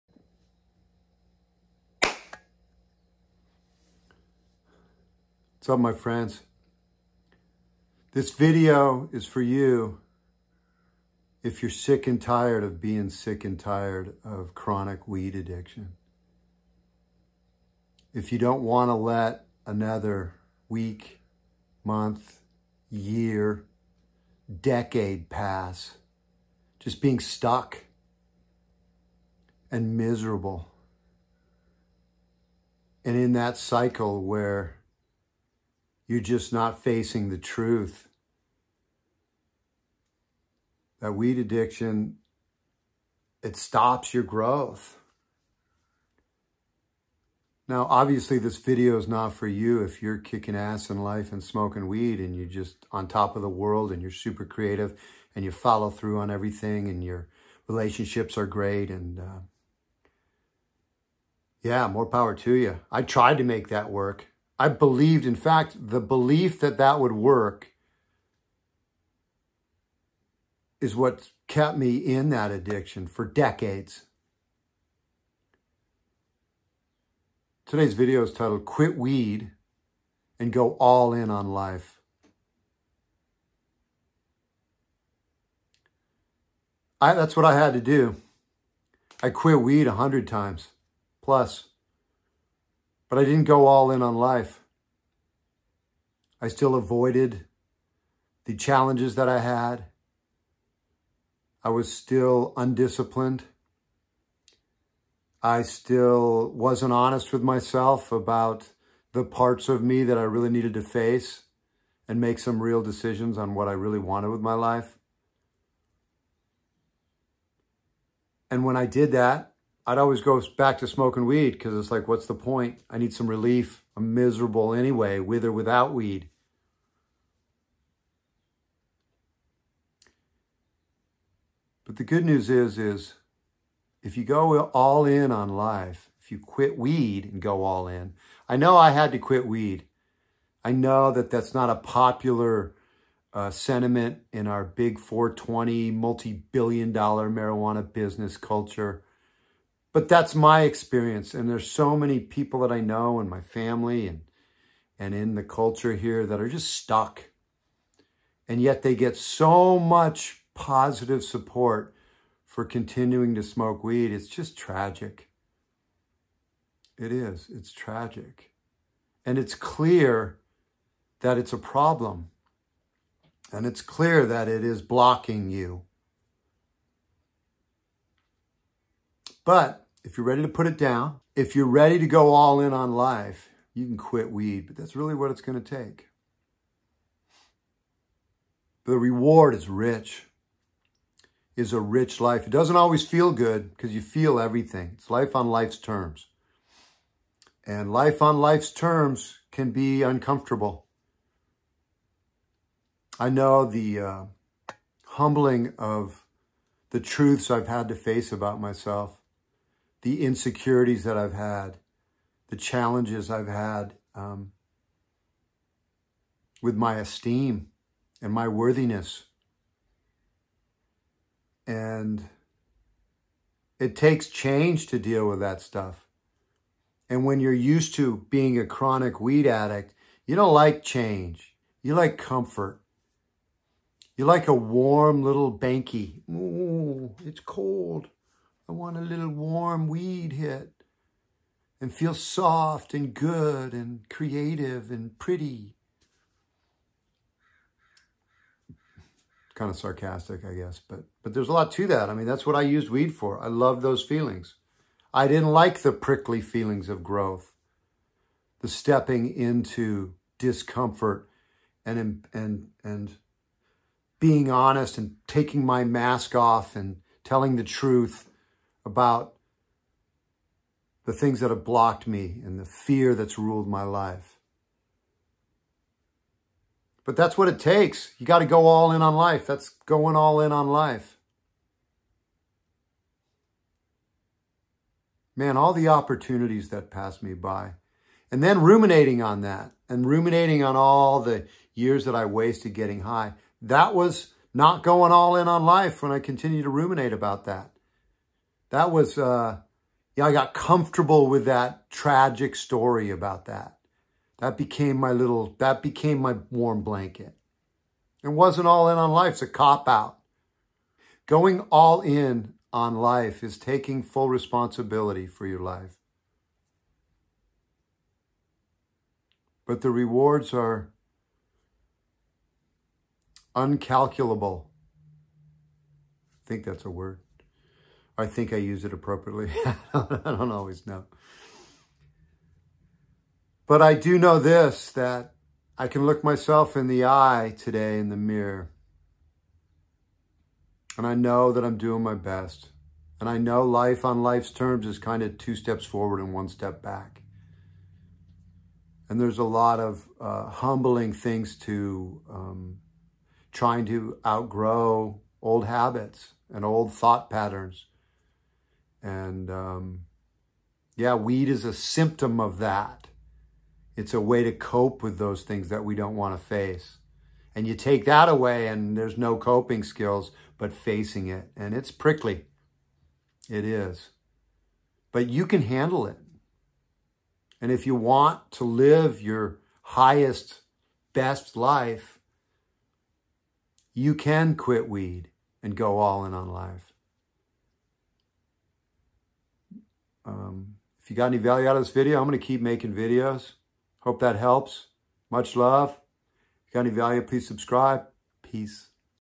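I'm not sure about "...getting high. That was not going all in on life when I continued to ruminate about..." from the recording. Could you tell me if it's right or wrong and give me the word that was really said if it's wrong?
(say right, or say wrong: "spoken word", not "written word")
right.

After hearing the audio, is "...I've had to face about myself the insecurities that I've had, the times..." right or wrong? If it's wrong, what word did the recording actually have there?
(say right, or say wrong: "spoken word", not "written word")
wrong: "challenges", not "times".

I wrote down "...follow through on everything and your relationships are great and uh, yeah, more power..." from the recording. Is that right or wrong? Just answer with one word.
right.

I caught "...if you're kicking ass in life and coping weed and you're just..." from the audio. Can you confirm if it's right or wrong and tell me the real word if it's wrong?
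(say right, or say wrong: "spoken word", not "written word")
wrong: "smoking", not "coping".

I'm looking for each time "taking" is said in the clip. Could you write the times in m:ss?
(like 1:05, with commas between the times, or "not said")
4:25, 5:13.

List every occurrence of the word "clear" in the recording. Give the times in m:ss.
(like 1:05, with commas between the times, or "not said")
2:49, 2:53.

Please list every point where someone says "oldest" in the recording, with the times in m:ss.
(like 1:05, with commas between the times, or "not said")
not said.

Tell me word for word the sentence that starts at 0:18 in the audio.
If you don't want to let another week, month, year, decade pass, just being stuck and miserable.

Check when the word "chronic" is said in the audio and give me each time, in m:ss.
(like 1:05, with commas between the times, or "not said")
0:14, 3:48.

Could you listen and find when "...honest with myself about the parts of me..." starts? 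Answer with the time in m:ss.
1:46.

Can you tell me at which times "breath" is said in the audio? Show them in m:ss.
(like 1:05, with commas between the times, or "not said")
not said.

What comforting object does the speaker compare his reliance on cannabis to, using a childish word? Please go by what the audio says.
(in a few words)
warm little banky.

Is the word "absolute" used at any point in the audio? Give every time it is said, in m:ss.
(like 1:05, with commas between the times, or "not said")
not said.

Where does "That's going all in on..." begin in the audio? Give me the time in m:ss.
4:39.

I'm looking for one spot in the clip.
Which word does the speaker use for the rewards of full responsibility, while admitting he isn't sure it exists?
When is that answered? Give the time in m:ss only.
5:23.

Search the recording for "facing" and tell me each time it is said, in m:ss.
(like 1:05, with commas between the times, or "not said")
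0:36, 6:10.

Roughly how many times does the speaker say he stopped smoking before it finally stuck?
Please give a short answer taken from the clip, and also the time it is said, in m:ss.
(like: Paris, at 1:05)
100 plus, at 1:29.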